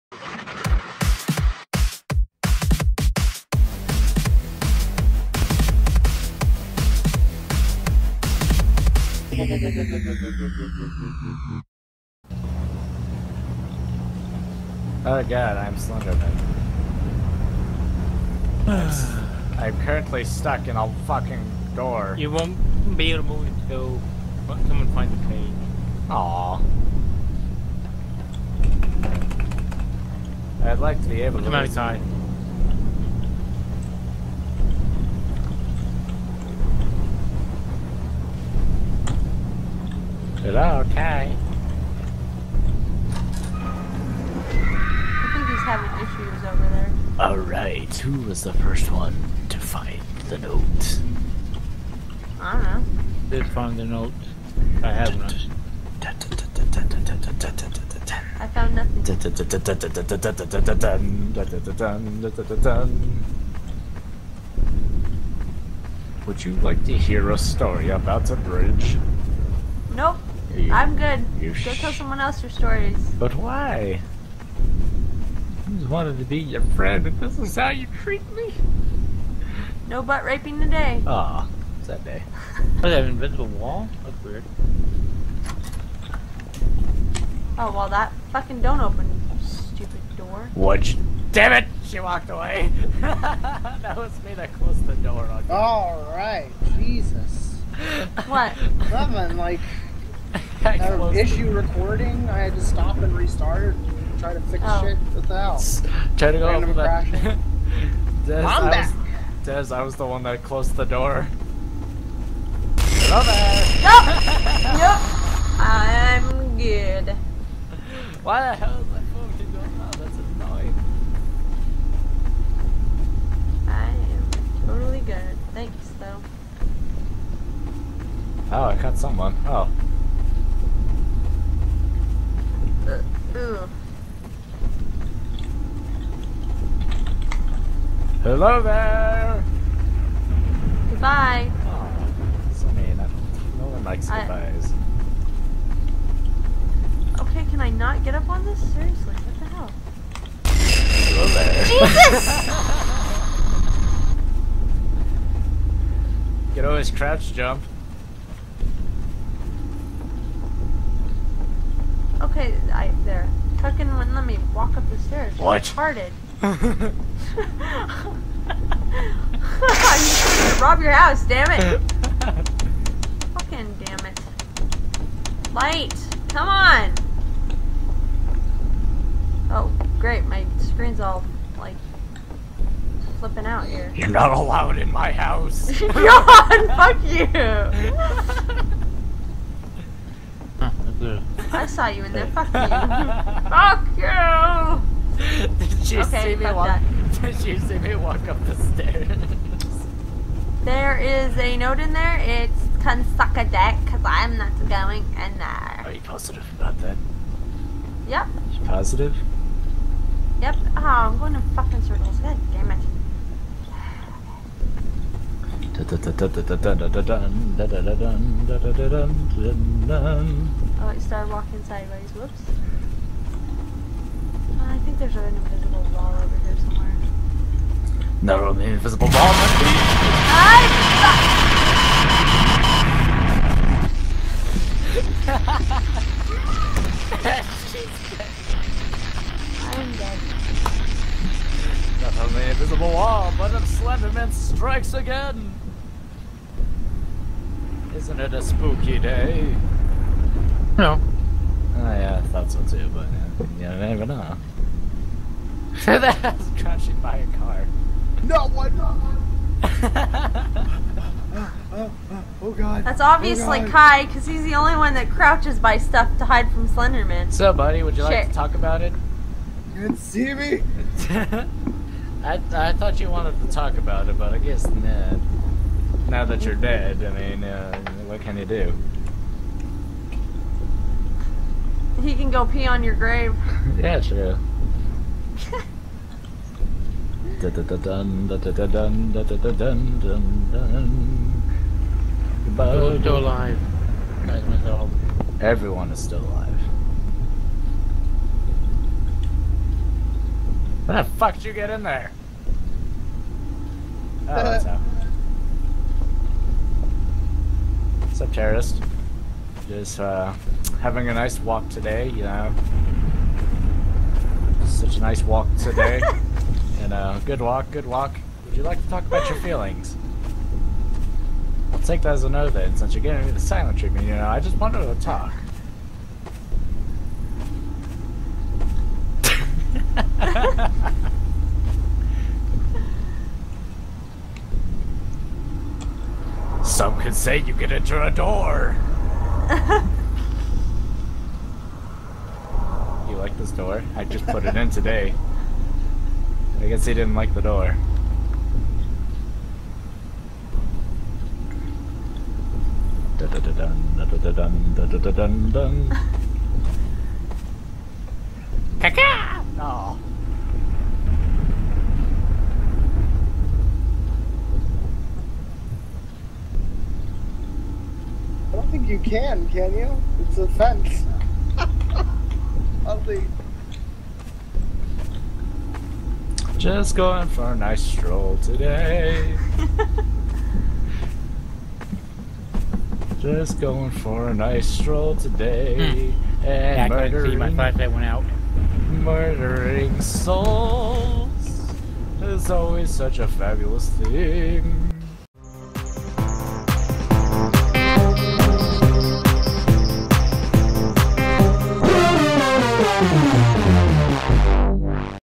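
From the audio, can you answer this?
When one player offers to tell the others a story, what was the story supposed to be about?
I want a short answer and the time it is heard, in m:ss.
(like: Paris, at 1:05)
A bridge, at 1:08.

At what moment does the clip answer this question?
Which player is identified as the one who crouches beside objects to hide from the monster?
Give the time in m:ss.
4:23.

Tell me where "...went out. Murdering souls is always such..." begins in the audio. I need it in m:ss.
6:27.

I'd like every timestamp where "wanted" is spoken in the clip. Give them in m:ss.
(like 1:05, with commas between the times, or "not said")
1:15, 4:33, 5:24.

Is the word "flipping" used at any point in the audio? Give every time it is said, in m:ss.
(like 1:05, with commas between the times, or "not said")
3:03.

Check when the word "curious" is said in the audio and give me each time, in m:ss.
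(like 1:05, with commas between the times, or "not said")
not said.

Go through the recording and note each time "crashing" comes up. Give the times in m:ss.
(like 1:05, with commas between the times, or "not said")
4:16.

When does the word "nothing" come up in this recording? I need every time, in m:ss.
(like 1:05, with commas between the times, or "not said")
0:58, 1:38.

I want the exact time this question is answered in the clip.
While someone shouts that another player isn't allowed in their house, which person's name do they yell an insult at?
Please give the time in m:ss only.
3:05.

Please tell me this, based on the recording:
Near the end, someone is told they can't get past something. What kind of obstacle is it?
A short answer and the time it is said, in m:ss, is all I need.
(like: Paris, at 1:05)
A fence, at 6:10.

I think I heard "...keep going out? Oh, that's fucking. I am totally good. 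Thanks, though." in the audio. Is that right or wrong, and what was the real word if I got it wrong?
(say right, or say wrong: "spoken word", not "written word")
wrong: "annoying", not "fucking".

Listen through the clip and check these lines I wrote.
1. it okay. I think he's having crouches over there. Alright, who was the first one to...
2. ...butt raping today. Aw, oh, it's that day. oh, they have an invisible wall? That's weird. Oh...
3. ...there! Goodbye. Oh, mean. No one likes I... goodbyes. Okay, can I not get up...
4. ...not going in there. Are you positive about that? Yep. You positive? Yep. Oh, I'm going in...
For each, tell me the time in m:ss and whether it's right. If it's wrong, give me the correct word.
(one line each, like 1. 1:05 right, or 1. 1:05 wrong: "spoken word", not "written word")
1. 0:40 wrong: "issues", not "crouches"
2. 1:20 right
3. 2:18 right
4. 3:24 right.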